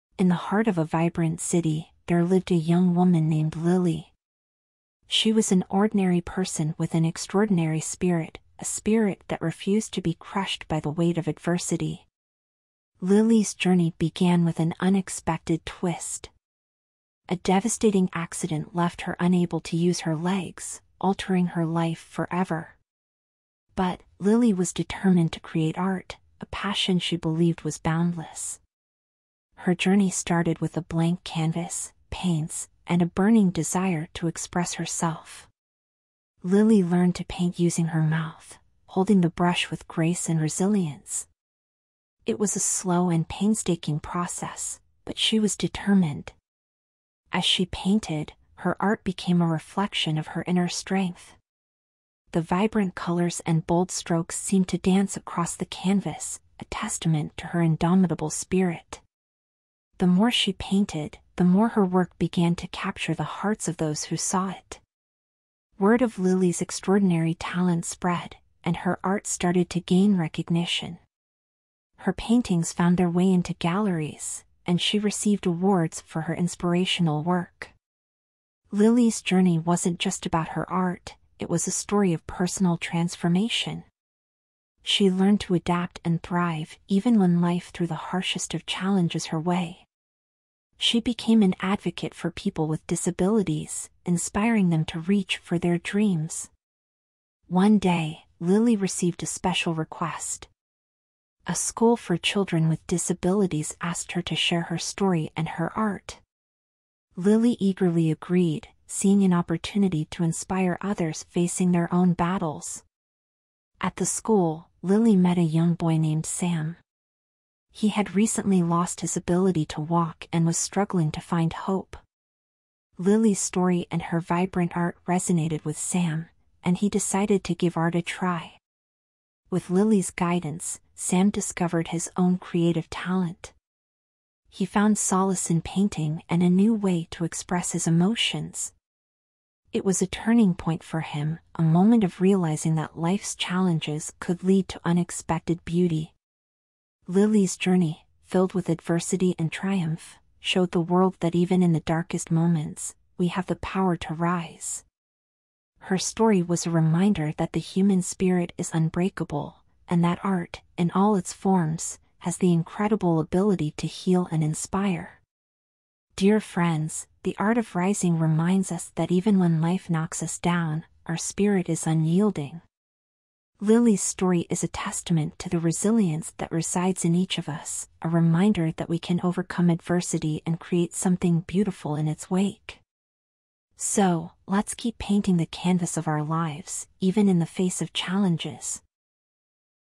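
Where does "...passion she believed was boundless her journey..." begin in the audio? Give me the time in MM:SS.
00:26.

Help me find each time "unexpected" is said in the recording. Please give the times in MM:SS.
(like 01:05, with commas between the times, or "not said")
00:14, 02:24.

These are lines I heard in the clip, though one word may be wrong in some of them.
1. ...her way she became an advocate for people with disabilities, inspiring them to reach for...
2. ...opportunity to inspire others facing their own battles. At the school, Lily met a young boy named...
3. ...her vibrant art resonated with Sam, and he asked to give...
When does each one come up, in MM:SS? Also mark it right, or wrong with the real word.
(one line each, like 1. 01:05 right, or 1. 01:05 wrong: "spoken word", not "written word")
1. 01:29 right
2. 01:49 right
3. 02:04 wrong: "decided", not "asked".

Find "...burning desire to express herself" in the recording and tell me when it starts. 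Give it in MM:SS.
00:33.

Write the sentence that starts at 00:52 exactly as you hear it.
The vibrant colors and bold strokes seemed to dance across the canvas, a testament to her indomitable spirit.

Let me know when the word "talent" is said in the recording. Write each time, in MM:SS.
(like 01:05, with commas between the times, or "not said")
01:07, 02:12.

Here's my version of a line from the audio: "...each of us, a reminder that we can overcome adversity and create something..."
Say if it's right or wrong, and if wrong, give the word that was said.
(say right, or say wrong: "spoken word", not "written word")
right.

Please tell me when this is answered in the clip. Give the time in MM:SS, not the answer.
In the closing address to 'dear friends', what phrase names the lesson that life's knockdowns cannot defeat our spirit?
02:47.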